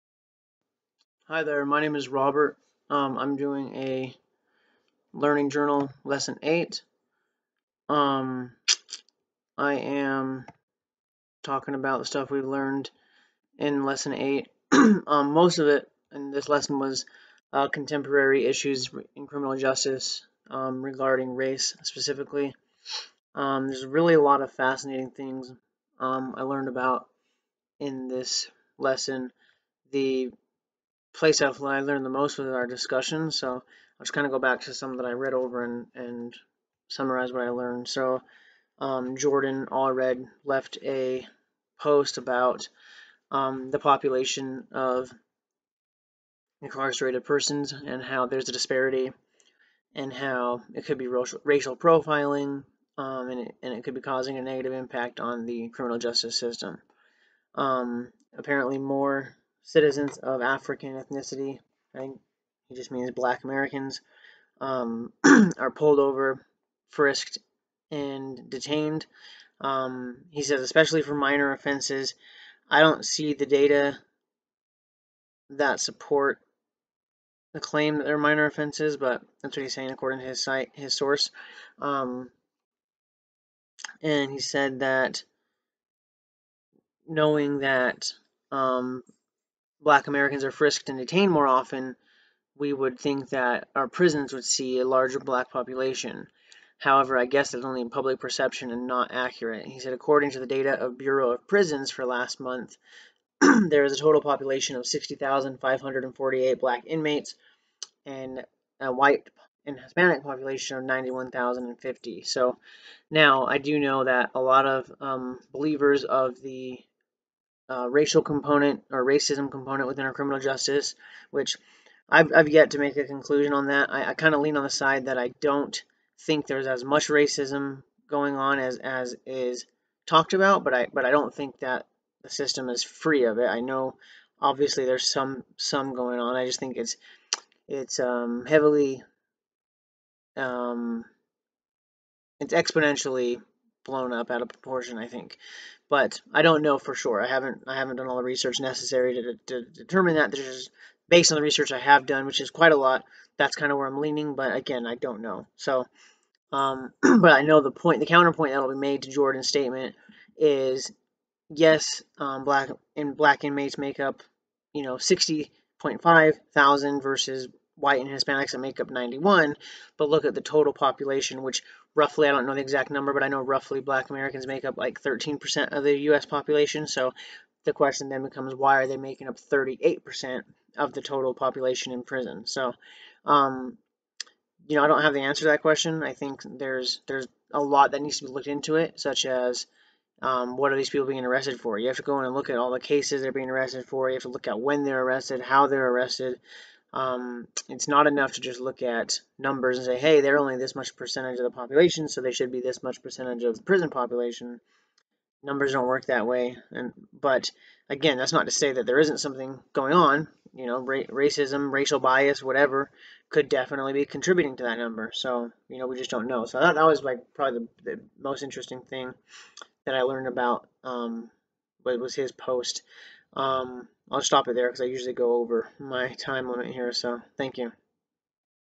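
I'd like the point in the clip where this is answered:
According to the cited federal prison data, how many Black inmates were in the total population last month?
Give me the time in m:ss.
1:44.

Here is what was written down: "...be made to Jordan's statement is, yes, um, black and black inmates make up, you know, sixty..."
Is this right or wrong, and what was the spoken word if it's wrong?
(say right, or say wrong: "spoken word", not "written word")
right.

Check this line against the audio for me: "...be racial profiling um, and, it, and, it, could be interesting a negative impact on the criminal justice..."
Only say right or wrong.
wrong.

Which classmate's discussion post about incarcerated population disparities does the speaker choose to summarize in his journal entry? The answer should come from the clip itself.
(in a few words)
Jordan Allred.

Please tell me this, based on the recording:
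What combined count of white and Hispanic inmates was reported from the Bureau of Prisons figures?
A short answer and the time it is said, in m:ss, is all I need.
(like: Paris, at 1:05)
91,050, at 1:50.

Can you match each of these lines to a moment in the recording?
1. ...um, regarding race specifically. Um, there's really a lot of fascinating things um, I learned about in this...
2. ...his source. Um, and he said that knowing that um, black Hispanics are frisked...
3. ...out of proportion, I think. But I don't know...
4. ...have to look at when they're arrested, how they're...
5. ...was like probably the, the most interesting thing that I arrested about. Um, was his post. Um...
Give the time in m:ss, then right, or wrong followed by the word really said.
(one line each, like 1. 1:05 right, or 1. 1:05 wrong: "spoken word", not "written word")
1. 0:20 right
2. 1:20 wrong: "Americans", not "Hispanics"
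3. 2:24 right
4. 3:14 right
5. 3:36 wrong: "learned", not "arrested".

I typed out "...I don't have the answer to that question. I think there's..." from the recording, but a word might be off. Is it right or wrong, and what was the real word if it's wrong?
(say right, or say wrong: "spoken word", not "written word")
right.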